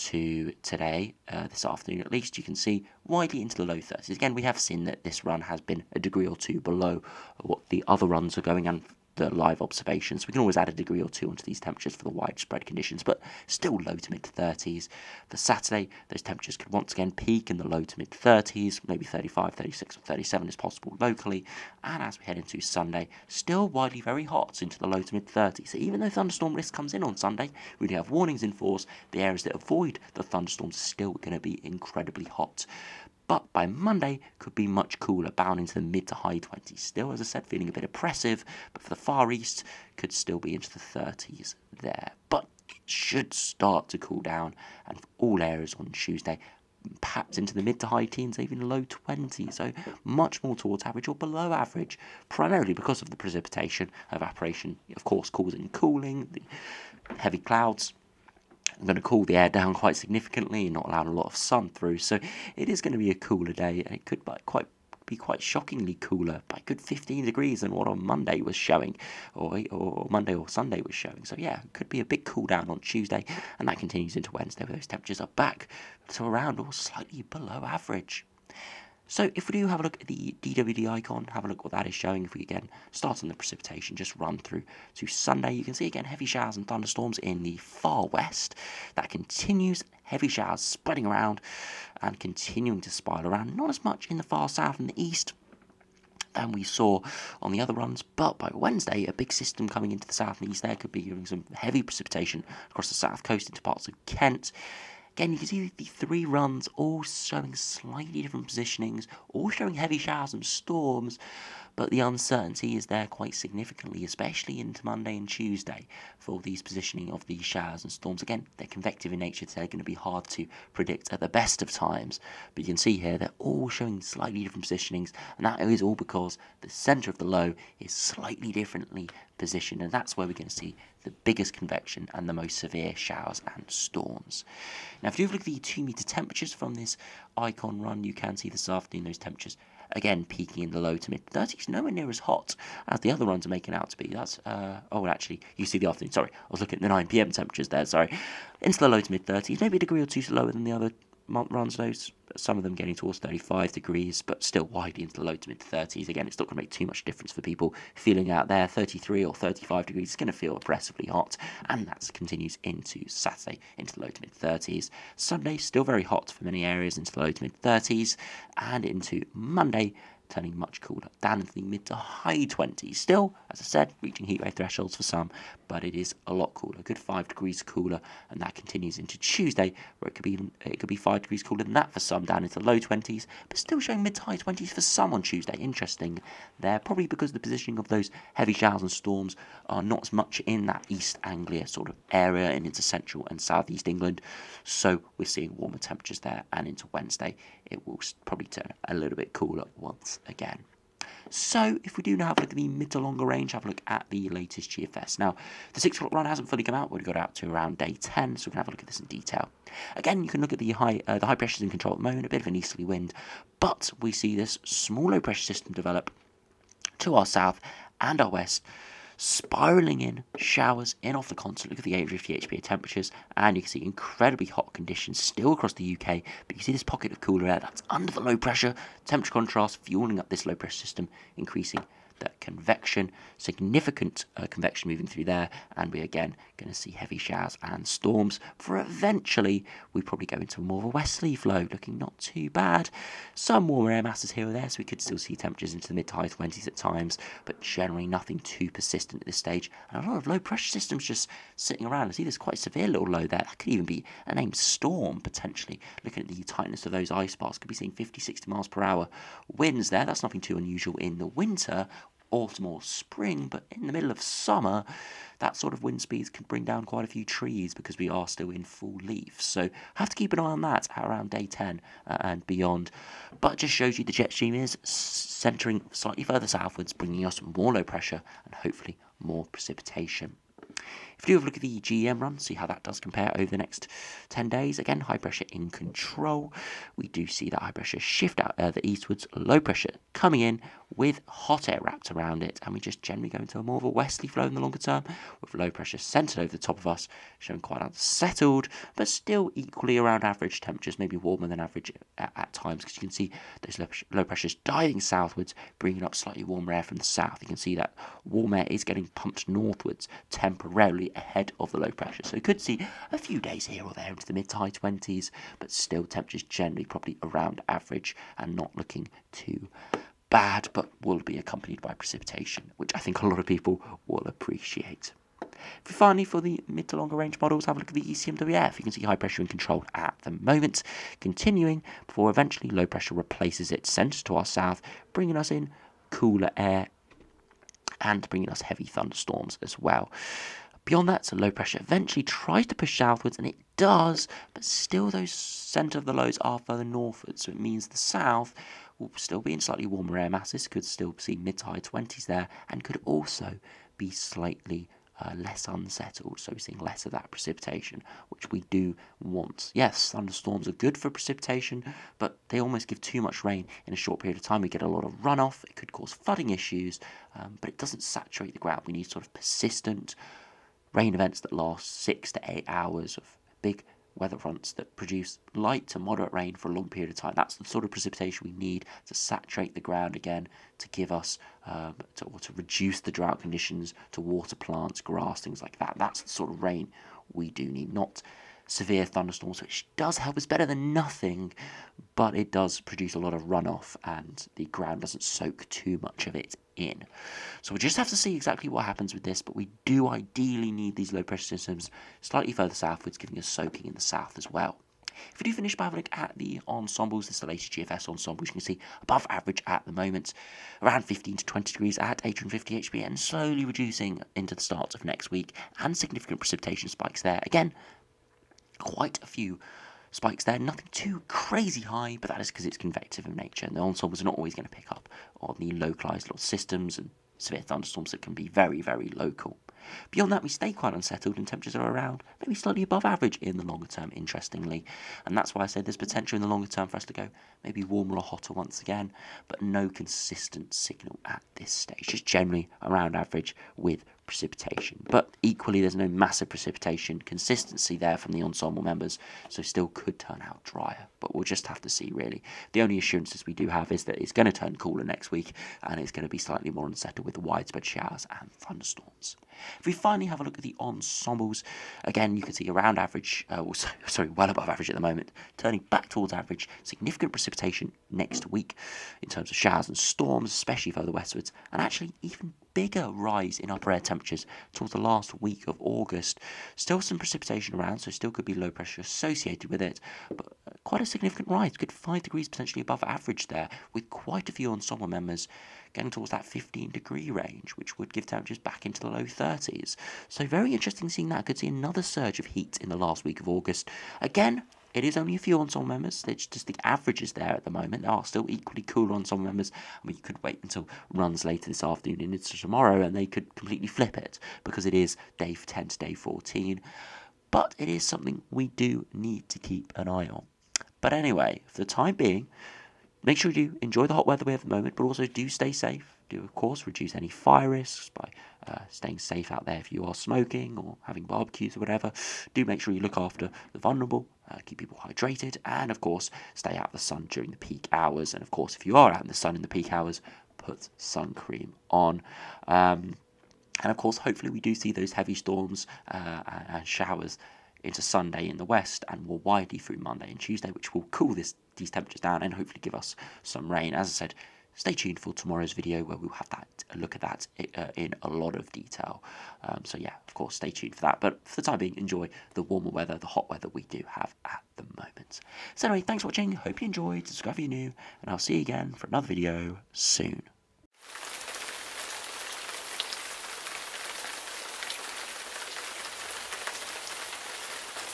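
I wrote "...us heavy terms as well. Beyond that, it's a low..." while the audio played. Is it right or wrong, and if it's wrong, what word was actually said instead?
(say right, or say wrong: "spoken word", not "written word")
wrong: "thunderstorms", not "terms".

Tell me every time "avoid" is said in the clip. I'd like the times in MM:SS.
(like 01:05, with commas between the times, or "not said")
00:29.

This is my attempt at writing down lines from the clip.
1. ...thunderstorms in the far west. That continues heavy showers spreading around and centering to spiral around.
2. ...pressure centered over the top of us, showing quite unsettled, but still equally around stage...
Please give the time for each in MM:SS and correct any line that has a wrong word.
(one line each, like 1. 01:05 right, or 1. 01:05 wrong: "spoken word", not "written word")
1. 01:26 wrong: "continuing", not "centering"
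2. 04:55 wrong: "average", not "stage".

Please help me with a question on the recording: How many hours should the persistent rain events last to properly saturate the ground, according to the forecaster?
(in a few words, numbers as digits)
6 to 8 hours.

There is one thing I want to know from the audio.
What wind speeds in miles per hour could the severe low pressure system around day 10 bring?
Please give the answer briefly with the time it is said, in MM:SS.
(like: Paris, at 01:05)
50-60 mph, at 04:17.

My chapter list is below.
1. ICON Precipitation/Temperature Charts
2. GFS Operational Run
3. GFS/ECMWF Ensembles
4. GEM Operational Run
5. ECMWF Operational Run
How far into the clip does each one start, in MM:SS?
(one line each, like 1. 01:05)
1. 01:20
2. 03:22
3. 06:45
4. 04:41
5. 05:25.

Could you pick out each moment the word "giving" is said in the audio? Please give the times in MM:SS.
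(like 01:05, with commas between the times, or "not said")
01:41, 06:43.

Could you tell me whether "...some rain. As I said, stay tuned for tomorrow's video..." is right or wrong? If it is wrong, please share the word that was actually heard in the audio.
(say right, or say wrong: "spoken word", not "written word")
right.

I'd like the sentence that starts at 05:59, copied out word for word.
Yes, thunderstorms are good for precipitation, but they almost give too much rain in a short period of time.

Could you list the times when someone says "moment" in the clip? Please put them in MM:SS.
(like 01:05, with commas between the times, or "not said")
03:32, 05:30, 06:49, 07:45, 08:17, 08:34, 09:14.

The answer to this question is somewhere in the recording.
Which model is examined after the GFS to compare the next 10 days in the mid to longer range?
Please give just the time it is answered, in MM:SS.
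04:41.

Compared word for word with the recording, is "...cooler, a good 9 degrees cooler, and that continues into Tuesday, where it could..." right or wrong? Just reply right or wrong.
wrong.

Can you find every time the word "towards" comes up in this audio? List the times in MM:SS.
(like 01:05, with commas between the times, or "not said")
00:50, 02:32, 07:46, 07:54, 08:06.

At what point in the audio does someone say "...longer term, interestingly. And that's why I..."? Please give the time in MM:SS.
07:13.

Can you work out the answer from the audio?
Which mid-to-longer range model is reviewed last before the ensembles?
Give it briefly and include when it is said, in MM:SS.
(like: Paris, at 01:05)
ECMWF, at 05:28.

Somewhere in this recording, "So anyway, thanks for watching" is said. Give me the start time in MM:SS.
09:15.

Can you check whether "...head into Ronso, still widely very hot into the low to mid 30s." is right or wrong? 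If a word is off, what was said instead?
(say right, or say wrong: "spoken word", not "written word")
wrong: "Sunday", not "Ronso".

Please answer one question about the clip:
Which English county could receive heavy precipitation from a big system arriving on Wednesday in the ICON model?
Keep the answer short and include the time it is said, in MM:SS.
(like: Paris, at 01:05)
Kent, at 01:44.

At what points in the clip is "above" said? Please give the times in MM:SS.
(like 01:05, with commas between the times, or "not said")
06:49, 07:12, 07:44, 08:02.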